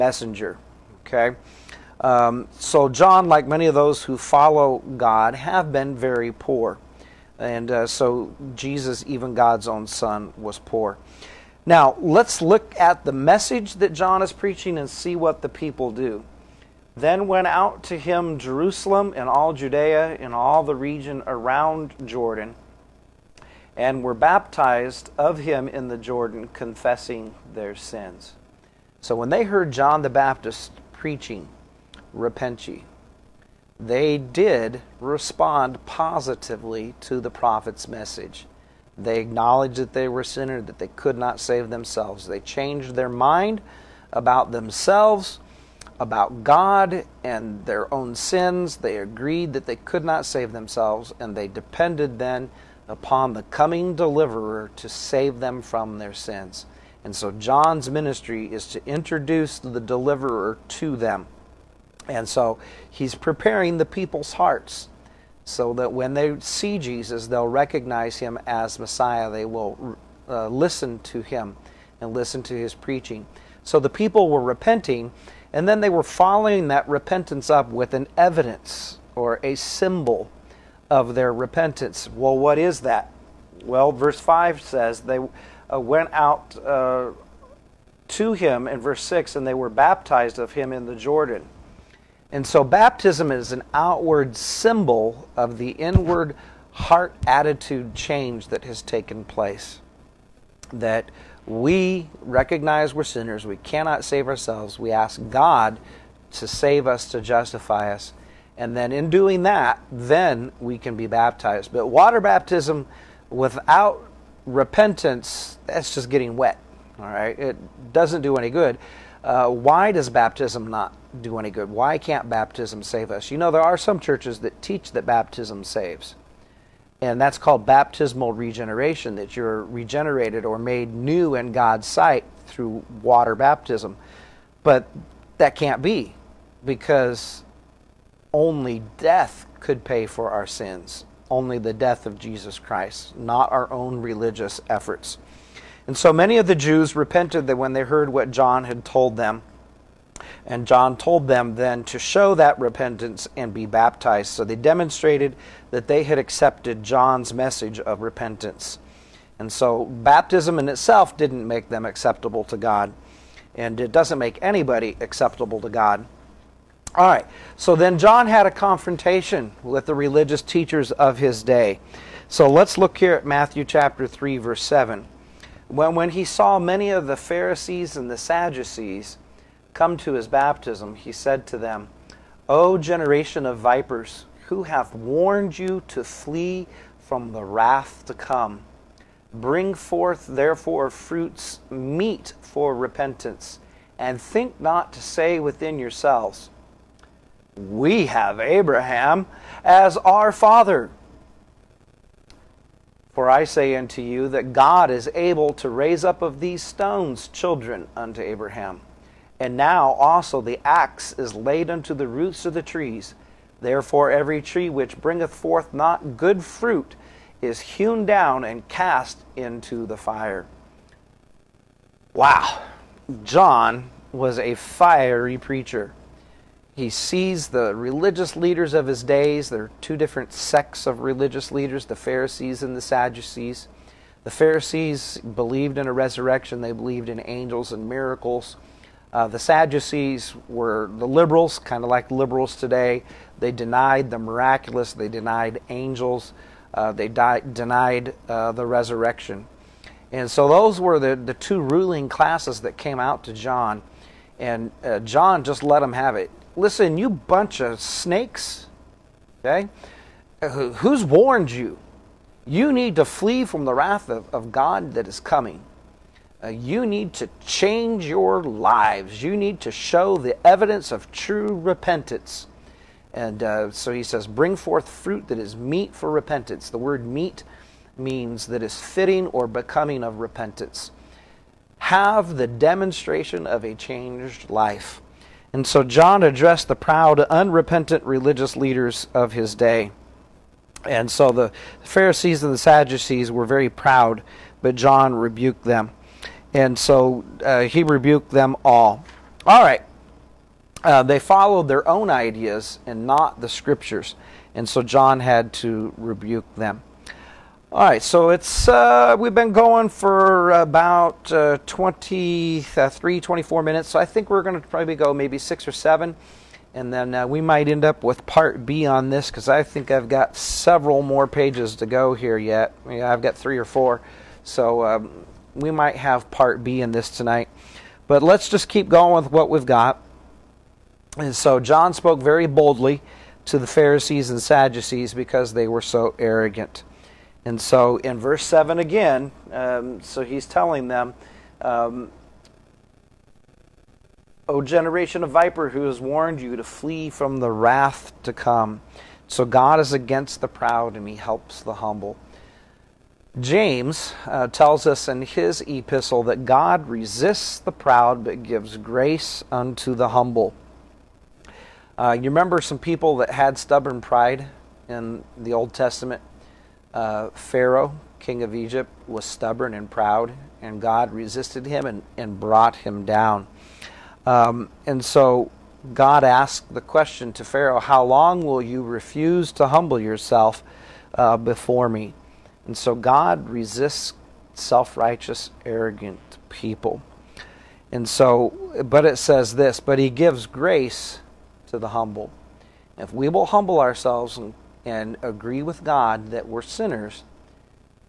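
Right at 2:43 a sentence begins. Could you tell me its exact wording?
And it doesn't make anybody acceptable to God.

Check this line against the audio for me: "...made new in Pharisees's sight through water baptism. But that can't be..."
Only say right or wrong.
wrong.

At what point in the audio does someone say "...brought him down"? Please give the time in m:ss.
6:12.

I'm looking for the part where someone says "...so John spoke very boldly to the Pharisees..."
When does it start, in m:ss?
5:31.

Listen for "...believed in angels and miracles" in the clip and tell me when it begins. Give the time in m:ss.
3:56.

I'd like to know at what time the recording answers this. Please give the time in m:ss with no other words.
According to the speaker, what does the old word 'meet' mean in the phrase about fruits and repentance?
4:38.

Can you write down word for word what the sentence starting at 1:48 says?
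And then in doing that, then we can be baptized.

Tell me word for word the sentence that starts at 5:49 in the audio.
So God is against the proud and he helps the humble.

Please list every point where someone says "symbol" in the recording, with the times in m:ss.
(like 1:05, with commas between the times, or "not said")
1:19, 1:34.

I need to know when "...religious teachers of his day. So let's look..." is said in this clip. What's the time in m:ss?
2:49.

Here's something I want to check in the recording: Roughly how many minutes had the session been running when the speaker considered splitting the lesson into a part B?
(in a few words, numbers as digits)
23 or 24.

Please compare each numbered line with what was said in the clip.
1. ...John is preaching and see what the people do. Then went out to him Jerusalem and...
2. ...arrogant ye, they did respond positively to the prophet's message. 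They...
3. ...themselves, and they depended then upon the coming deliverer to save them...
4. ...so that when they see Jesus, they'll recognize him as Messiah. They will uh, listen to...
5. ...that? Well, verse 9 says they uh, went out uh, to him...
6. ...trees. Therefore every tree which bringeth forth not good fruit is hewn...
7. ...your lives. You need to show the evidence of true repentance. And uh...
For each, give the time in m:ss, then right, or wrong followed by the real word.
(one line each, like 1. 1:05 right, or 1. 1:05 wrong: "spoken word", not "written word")
1. 0:13 right
2. 0:32 wrong: "repent", not "arrogant"
3. 0:50 right
4. 1:05 right
5. 1:22 wrong: "5", not "9"
6. 3:32 right
7. 4:28 right.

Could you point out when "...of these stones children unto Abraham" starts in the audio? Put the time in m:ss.
3:26.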